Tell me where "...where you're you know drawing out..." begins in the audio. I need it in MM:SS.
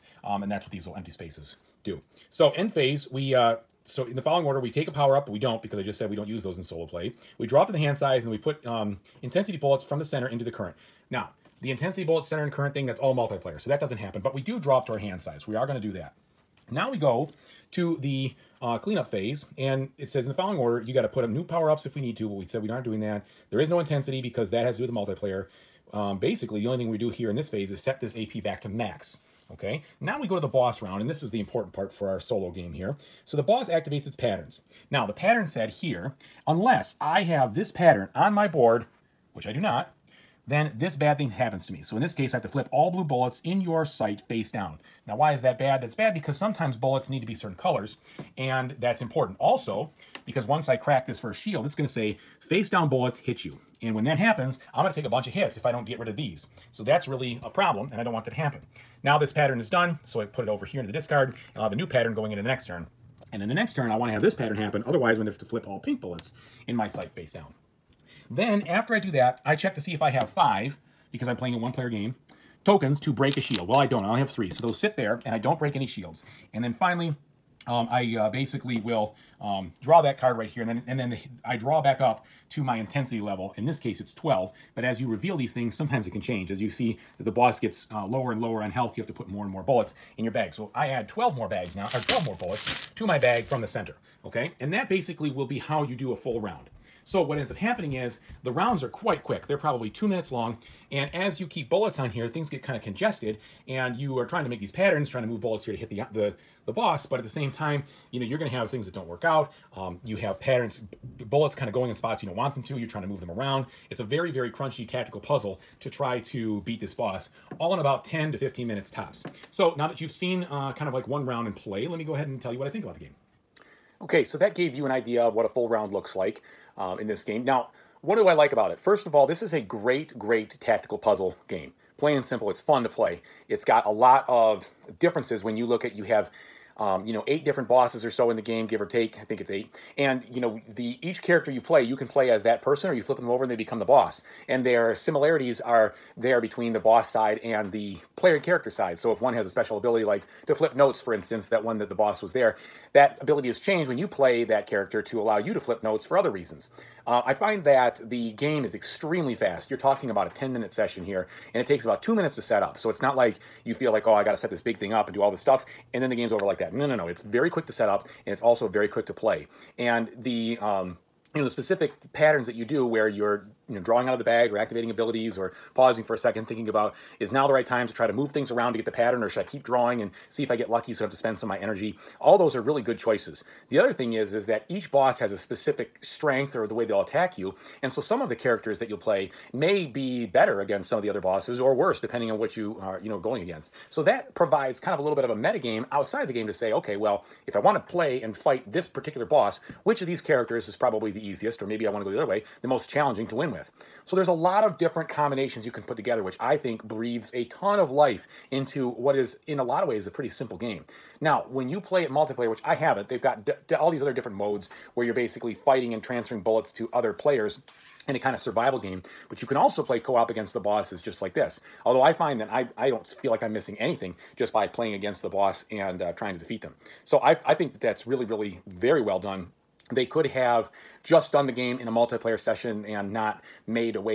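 02:52.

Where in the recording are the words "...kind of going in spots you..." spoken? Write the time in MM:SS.
01:51.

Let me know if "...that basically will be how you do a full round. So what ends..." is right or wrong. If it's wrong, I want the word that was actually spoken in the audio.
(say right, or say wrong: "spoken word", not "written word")
right.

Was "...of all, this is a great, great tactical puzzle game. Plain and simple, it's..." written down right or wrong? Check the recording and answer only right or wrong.
right.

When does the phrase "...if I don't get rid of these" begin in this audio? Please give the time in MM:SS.
00:55.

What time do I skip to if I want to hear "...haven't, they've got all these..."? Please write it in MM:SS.
03:32.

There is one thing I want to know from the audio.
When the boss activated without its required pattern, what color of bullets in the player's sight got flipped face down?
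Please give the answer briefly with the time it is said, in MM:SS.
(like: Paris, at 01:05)
blue, at 00:42.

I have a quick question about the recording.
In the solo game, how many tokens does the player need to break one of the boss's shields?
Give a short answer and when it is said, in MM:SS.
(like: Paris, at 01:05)
5, at 01:10.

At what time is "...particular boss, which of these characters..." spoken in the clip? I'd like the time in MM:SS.
03:18.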